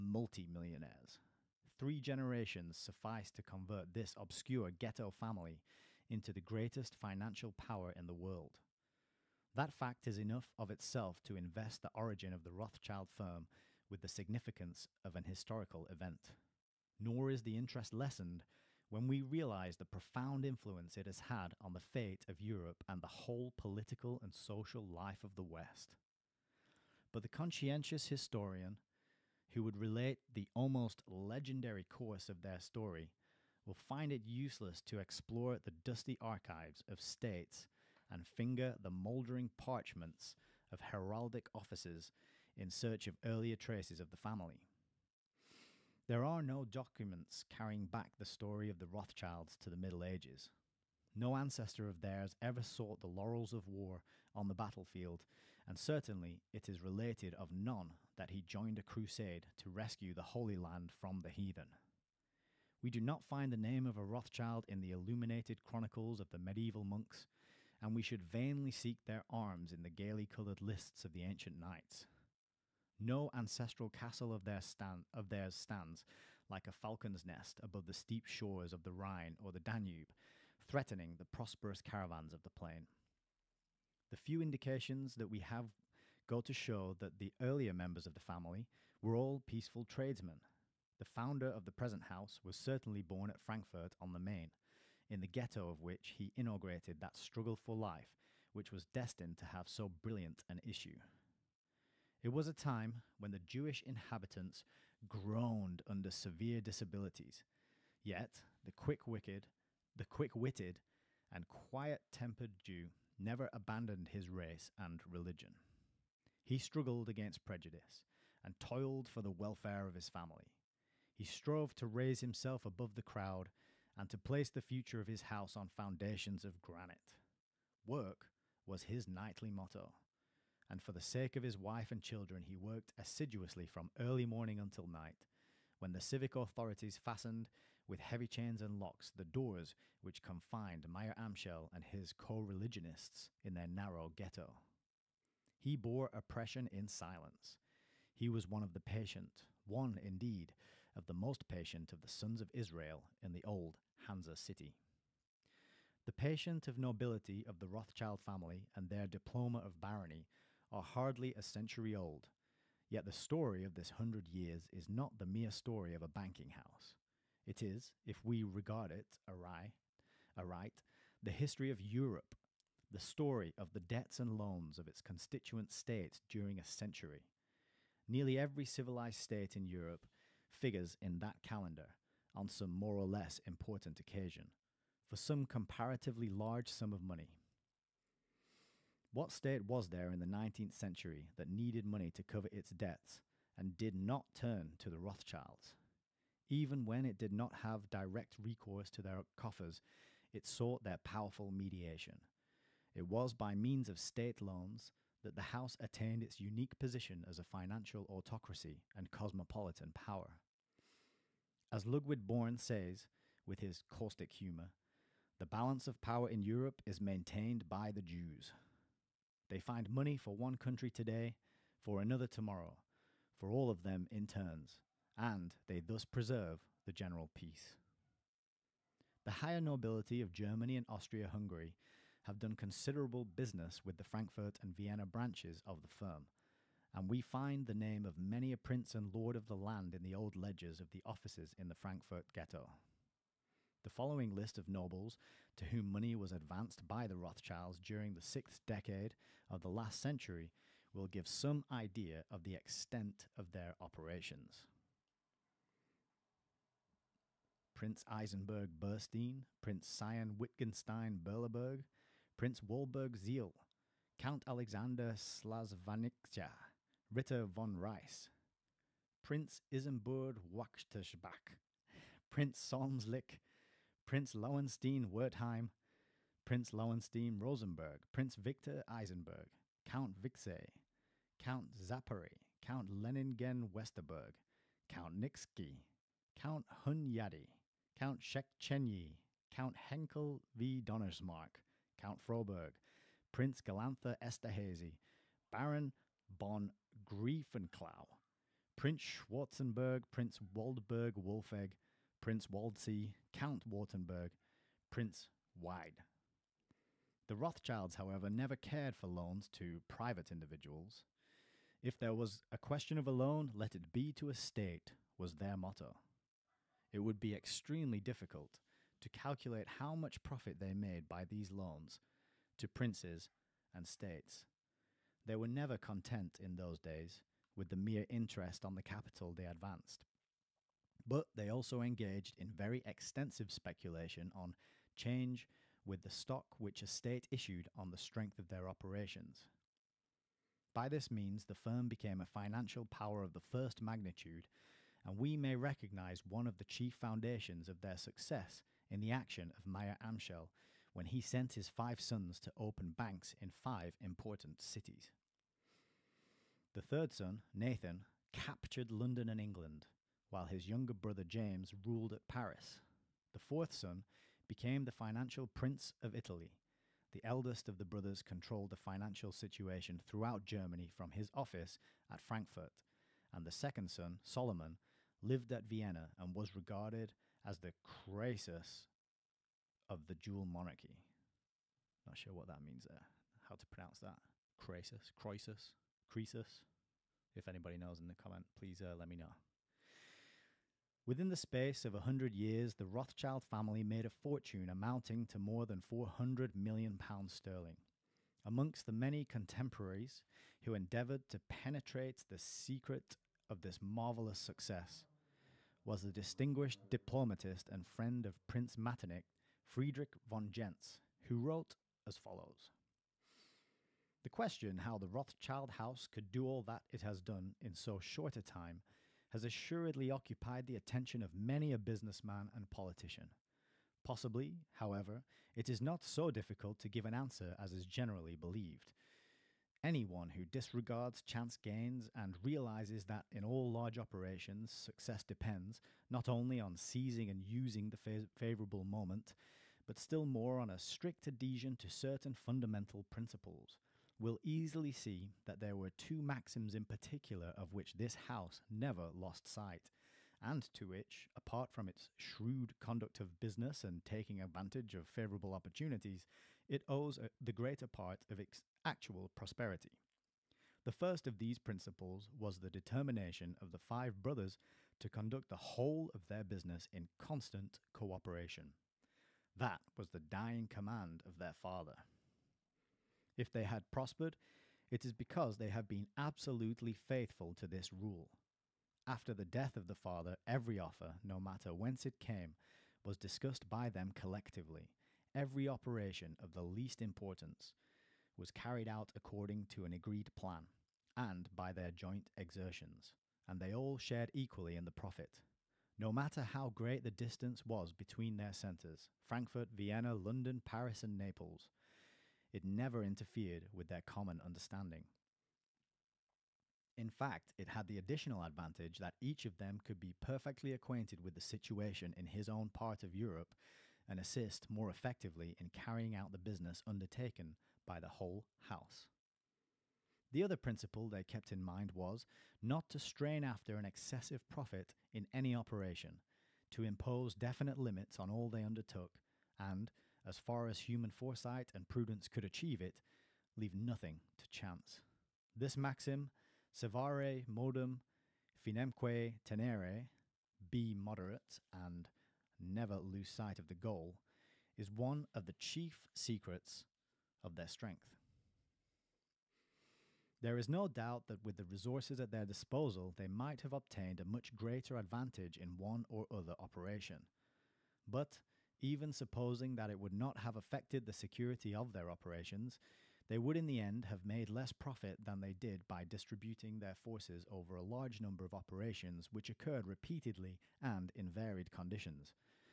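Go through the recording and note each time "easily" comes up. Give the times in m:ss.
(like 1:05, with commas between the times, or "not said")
7:24.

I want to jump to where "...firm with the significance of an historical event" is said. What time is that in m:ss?
0:13.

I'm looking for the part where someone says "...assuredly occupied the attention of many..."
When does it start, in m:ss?
6:59.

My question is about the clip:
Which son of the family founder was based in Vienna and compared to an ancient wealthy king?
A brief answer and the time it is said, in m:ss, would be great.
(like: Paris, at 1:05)
Solomon, at 6:14.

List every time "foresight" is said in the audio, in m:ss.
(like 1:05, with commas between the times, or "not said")
8:51.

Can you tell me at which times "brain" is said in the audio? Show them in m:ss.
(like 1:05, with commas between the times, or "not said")
not said.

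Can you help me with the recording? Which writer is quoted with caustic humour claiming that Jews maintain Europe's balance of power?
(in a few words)
Ludwig Born.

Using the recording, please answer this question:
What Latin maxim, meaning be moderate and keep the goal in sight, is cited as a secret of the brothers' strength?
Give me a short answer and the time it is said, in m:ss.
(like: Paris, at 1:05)
Servare modum, finemque tenere, at 8:56.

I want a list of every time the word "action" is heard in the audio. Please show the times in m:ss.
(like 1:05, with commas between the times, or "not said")
5:49.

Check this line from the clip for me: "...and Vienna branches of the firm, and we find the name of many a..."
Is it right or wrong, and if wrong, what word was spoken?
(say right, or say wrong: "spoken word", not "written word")
right.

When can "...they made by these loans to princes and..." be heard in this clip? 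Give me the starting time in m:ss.
5:20.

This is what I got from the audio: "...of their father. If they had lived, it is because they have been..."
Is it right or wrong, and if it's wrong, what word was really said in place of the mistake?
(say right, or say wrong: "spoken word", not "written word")
wrong: "prospered", not "lived".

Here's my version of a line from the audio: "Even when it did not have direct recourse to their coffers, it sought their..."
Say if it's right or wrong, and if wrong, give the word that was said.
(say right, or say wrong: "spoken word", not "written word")
right.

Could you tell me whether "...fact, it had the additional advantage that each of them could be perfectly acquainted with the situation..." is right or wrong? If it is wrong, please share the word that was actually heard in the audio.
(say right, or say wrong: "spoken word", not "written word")
right.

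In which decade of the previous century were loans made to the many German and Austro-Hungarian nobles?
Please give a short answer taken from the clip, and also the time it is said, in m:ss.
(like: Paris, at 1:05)
The sixth decade, at 4:08.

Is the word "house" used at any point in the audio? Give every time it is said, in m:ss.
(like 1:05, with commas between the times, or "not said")
1:32, 2:05, 2:46, 3:25, 6:55, 7:28, 8:38.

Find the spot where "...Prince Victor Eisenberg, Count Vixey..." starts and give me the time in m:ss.
4:38.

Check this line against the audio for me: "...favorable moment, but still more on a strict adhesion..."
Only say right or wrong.
right.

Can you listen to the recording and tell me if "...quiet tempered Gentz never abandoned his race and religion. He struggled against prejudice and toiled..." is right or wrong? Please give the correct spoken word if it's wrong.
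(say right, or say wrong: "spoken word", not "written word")
wrong: "Jew", not "Gentz".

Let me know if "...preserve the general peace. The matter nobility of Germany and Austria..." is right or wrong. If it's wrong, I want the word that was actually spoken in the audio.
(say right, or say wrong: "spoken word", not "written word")
wrong: "higher", not "matter".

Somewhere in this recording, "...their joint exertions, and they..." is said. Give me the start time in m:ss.
8:11.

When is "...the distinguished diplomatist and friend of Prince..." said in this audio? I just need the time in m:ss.
6:46.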